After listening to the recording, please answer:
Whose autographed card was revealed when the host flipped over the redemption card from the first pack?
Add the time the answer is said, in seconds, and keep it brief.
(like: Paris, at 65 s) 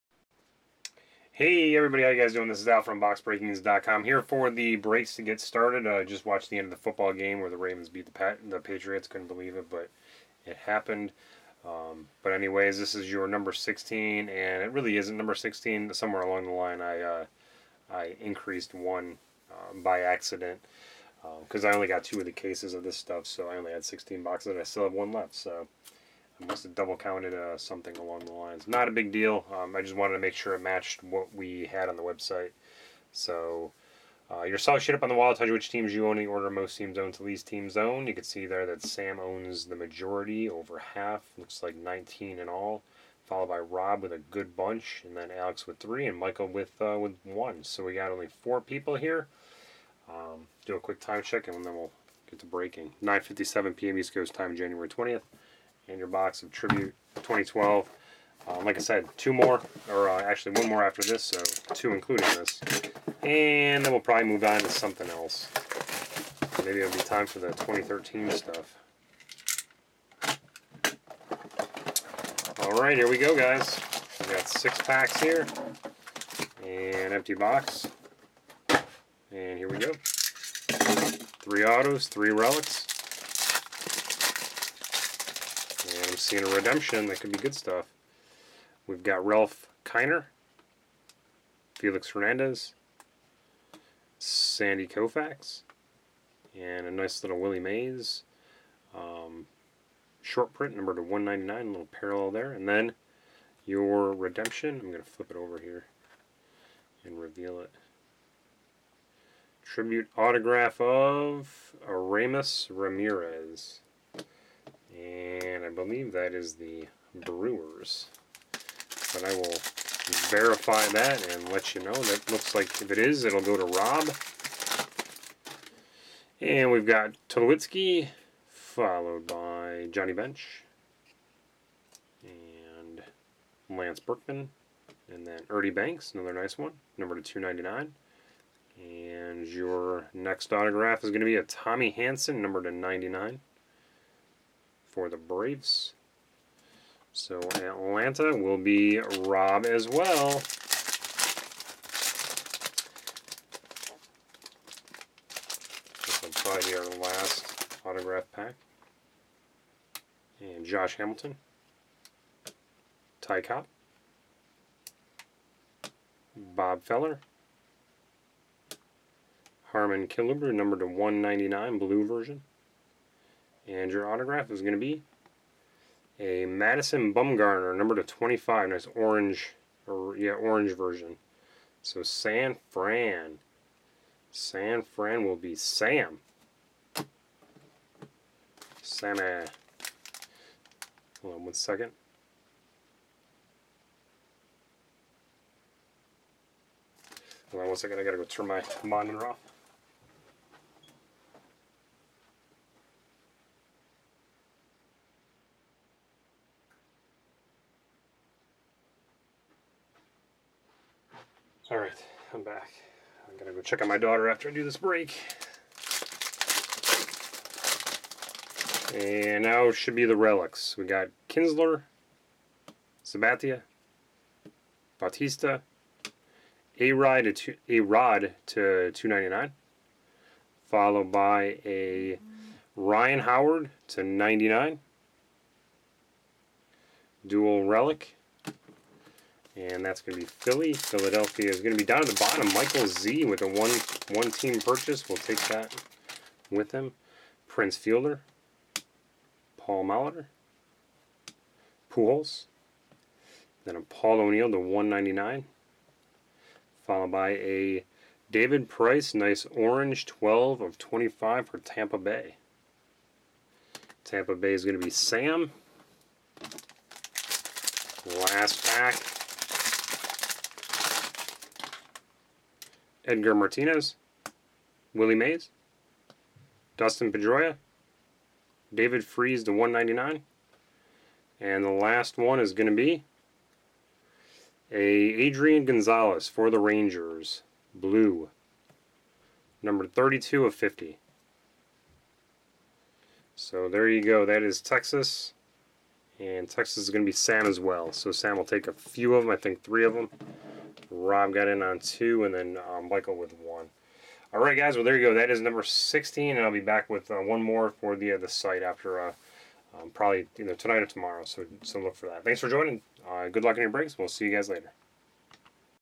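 Aramis Ramirez, at 111 s.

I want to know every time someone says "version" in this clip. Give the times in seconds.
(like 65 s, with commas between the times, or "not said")
172 s, 180 s.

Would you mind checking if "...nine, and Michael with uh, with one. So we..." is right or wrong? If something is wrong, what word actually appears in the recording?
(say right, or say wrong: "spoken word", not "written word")
wrong: "three", not "nine".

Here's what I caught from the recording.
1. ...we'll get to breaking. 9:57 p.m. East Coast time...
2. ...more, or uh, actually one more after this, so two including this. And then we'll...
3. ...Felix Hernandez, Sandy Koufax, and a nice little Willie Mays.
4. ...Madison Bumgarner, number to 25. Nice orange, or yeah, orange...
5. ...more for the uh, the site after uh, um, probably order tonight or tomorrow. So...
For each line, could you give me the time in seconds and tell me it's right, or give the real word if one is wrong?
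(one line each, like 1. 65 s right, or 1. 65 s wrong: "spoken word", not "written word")
1. 51 s right
2. 59 s right
3. 91 s right
4. 176 s right
5. 307 s wrong: "either", not "order".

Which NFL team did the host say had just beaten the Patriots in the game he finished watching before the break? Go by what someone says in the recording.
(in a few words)
Ravens.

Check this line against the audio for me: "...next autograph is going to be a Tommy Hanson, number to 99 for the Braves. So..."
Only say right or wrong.
right.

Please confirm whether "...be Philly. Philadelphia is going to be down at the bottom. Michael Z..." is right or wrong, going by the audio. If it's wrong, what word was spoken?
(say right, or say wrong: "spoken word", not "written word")
right.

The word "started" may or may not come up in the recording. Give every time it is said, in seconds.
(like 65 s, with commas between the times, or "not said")
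5 s.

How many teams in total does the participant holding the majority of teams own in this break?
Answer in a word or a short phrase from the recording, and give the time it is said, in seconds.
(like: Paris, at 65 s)
19, at 41 s.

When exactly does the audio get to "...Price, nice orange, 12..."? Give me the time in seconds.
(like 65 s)
258 s.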